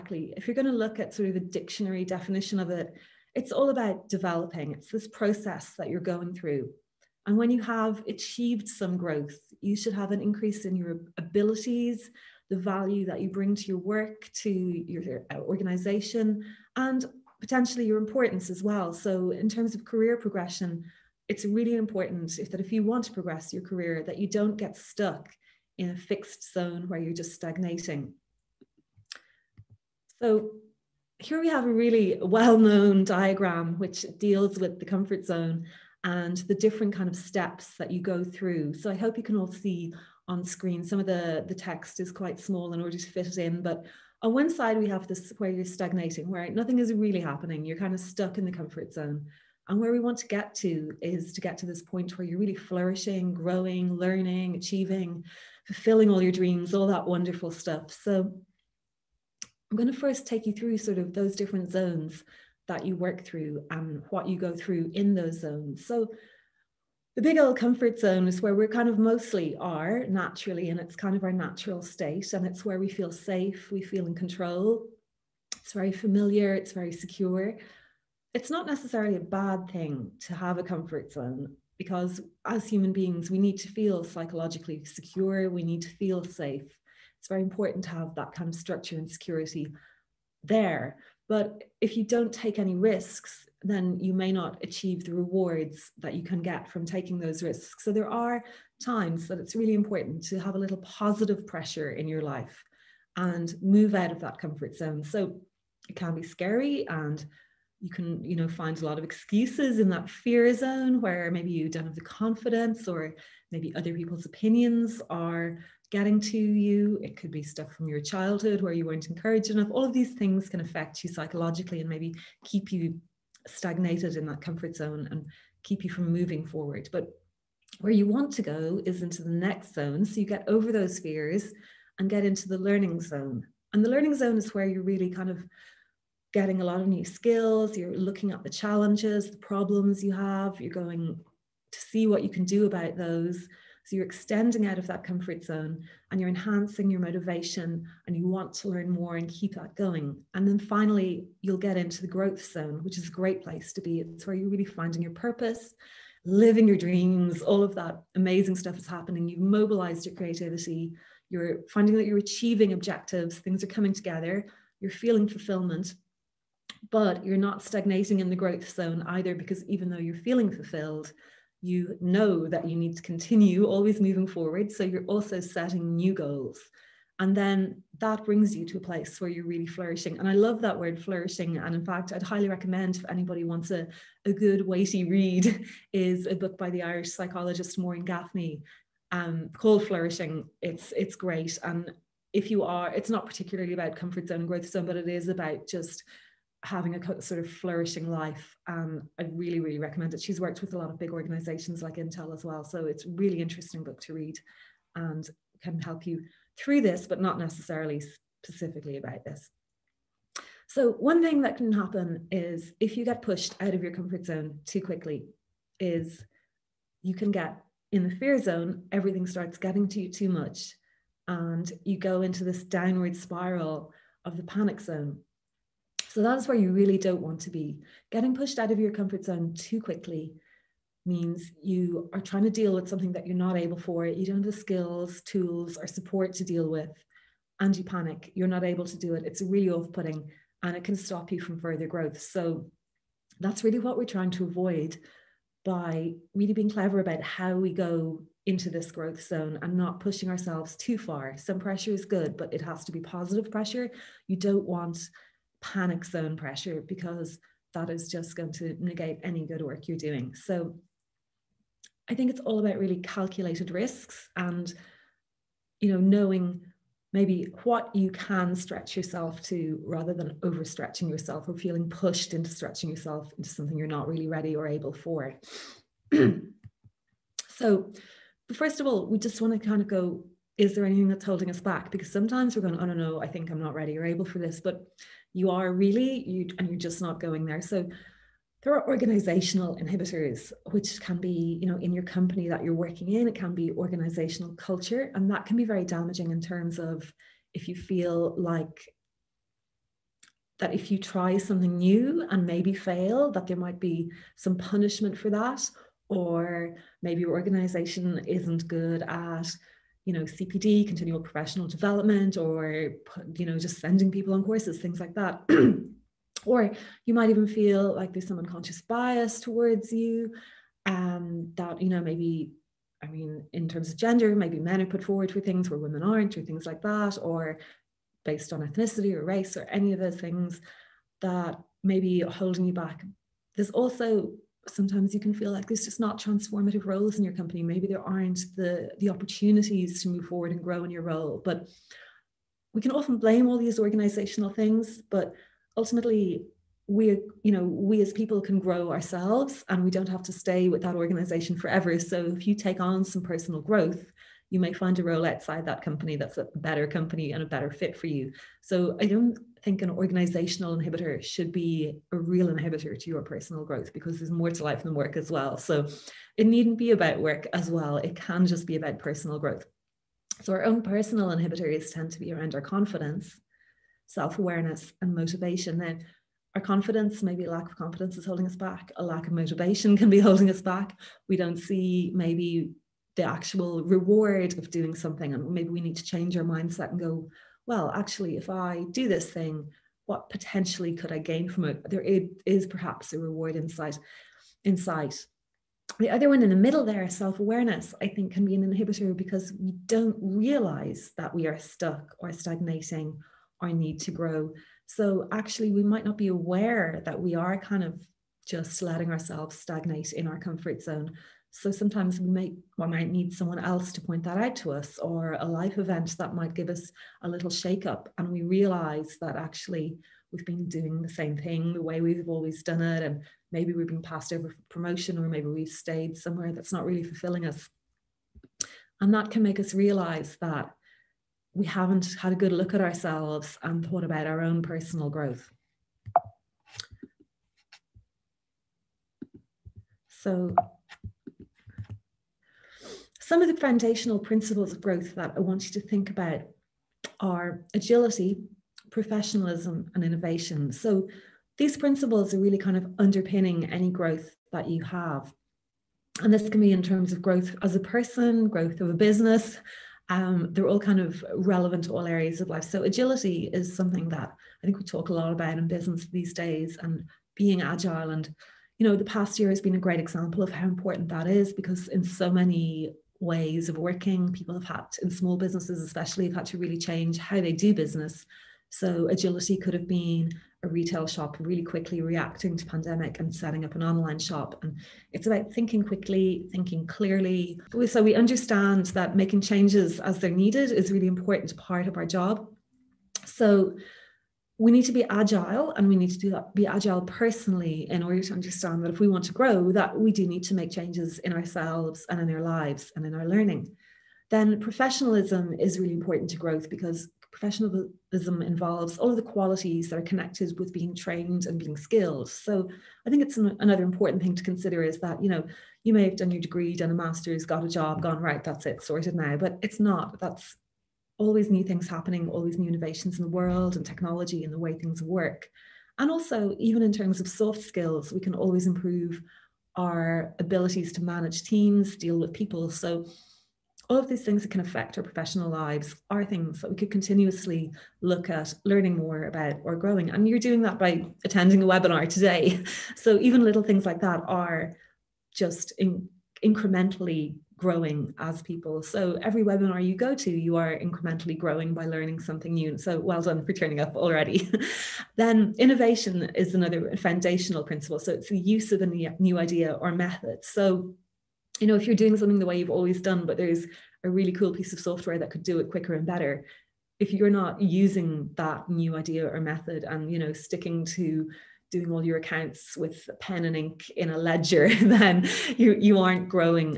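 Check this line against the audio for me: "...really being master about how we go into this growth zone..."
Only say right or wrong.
wrong.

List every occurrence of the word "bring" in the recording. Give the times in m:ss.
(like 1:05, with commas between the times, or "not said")
0:13, 2:58.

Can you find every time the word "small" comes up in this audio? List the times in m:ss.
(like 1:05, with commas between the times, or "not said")
0:42, 7:55.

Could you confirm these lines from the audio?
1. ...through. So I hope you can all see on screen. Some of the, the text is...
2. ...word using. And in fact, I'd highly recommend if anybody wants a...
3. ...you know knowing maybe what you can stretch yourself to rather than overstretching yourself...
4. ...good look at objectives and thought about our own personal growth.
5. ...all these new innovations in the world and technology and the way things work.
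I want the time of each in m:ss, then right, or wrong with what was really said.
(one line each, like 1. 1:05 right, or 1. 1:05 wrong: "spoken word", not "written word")
1. 0:38 right
2. 3:00 wrong: "flourishing", not "using"
3. 4:25 right
4. 7:12 wrong: "ourselves", not "objectives"
5. 8:42 right.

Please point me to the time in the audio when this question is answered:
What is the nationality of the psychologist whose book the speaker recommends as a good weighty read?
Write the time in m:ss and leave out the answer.
3:06.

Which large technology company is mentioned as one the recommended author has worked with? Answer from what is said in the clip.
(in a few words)
Intel.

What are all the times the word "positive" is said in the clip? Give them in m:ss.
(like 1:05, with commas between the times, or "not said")
1:40, 4:12.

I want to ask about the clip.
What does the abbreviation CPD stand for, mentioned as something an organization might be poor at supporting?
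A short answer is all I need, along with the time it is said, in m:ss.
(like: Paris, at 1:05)
continual professional development, at 5:10.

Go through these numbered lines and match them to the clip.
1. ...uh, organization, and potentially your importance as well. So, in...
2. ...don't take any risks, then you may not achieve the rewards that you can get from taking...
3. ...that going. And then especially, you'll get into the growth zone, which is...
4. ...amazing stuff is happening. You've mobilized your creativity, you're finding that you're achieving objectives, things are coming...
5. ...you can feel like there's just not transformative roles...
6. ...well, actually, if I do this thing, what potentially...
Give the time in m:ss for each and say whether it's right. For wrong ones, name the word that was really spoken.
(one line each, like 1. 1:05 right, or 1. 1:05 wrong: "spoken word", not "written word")
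1. 0:15 right
2. 1:32 right
3. 2:29 wrong: "finally", not "especially"
4. 2:38 right
5. 5:35 right
6. 6:27 right.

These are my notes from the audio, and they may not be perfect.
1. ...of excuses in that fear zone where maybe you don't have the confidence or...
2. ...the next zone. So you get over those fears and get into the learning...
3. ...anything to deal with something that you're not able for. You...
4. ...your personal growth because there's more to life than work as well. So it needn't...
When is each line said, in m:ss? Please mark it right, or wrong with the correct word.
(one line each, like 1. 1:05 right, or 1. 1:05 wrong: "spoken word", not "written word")
1. 1:48 right
2. 2:09 right
3. 3:52 wrong: "trying", not "anything"
4. 6:03 right.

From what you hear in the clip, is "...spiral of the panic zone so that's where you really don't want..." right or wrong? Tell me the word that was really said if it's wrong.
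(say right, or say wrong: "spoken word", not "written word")
right.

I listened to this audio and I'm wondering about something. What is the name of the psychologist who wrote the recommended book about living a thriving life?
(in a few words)
Maureen Gaffney.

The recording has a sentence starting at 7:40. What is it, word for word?
Um, they're all kind of relevant to all areas of life.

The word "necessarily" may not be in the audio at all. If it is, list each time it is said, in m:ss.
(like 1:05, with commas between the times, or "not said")
1:18, 3:27.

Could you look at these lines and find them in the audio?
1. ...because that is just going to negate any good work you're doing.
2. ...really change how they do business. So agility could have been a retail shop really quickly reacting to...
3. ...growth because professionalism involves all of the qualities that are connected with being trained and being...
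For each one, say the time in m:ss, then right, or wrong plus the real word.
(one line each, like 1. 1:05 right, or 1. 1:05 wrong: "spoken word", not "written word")
1. 4:16 right
2. 7:56 right
3. 8:26 right.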